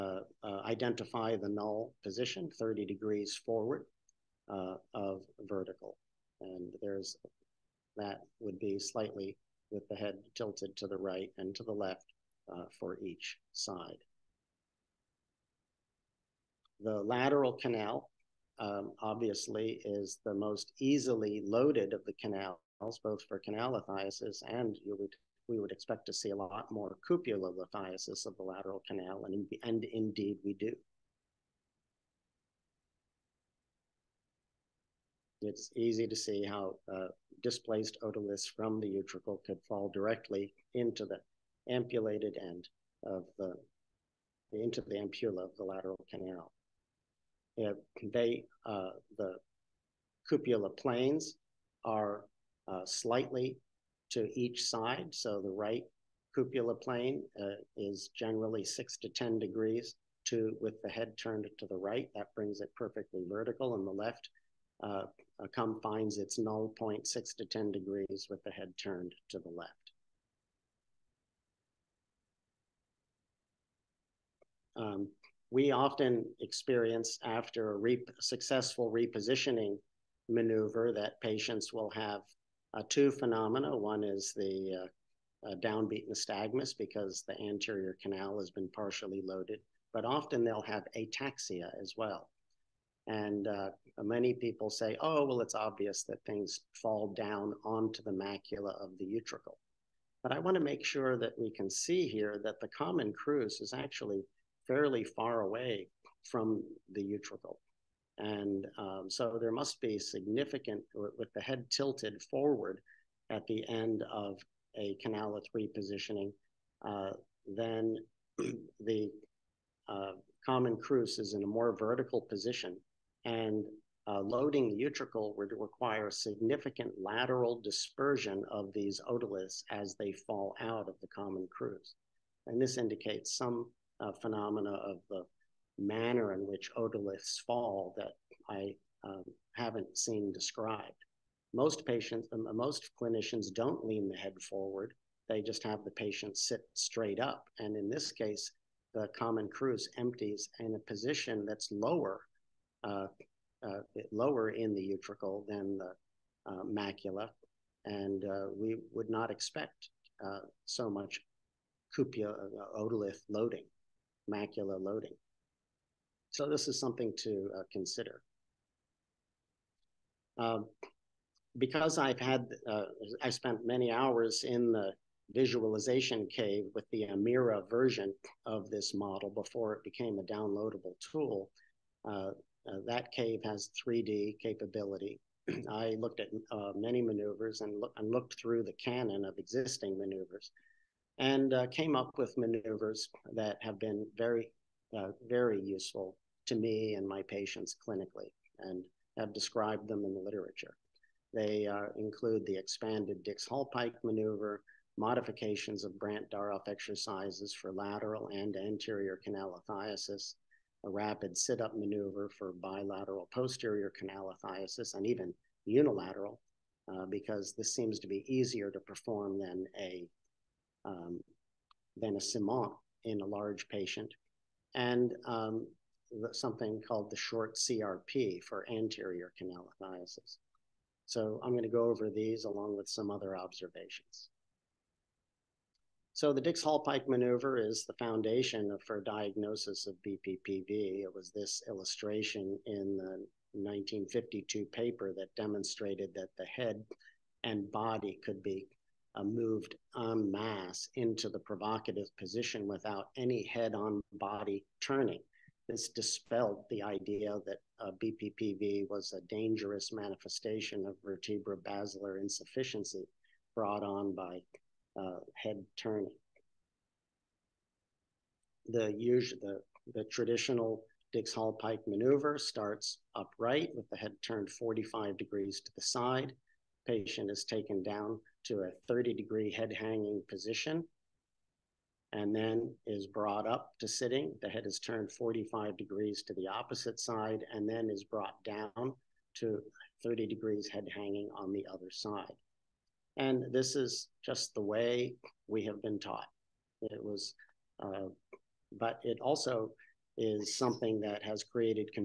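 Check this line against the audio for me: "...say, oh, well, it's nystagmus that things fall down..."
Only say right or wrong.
wrong.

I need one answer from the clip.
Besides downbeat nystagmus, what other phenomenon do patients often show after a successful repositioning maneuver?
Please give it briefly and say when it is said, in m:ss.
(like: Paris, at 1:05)
ataxia, at 1:30.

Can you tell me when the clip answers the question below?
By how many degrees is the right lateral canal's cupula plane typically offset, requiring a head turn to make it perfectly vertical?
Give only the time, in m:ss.
0:58.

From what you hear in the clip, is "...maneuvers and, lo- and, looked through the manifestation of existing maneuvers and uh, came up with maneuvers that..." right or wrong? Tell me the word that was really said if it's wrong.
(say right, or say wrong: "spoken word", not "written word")
wrong: "canon", not "manifestation".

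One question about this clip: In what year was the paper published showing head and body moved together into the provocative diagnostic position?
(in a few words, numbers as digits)
1952.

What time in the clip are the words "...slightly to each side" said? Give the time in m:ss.
0:52.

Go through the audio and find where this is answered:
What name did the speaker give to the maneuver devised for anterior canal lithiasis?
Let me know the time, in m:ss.
3:47.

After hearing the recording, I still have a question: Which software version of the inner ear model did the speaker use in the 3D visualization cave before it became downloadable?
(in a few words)
Amira.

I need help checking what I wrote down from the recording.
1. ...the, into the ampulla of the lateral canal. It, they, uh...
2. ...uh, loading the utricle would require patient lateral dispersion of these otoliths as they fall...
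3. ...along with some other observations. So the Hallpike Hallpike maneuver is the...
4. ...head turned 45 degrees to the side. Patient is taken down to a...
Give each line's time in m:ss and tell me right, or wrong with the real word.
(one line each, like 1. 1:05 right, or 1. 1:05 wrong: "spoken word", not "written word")
1. 0:43 right
2. 2:04 wrong: "significant", not "patient"
3. 3:52 wrong: "Dix", not "Hallpike"
4. 4:33 right.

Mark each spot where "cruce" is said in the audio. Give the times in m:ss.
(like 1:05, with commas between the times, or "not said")
1:43, 2:00.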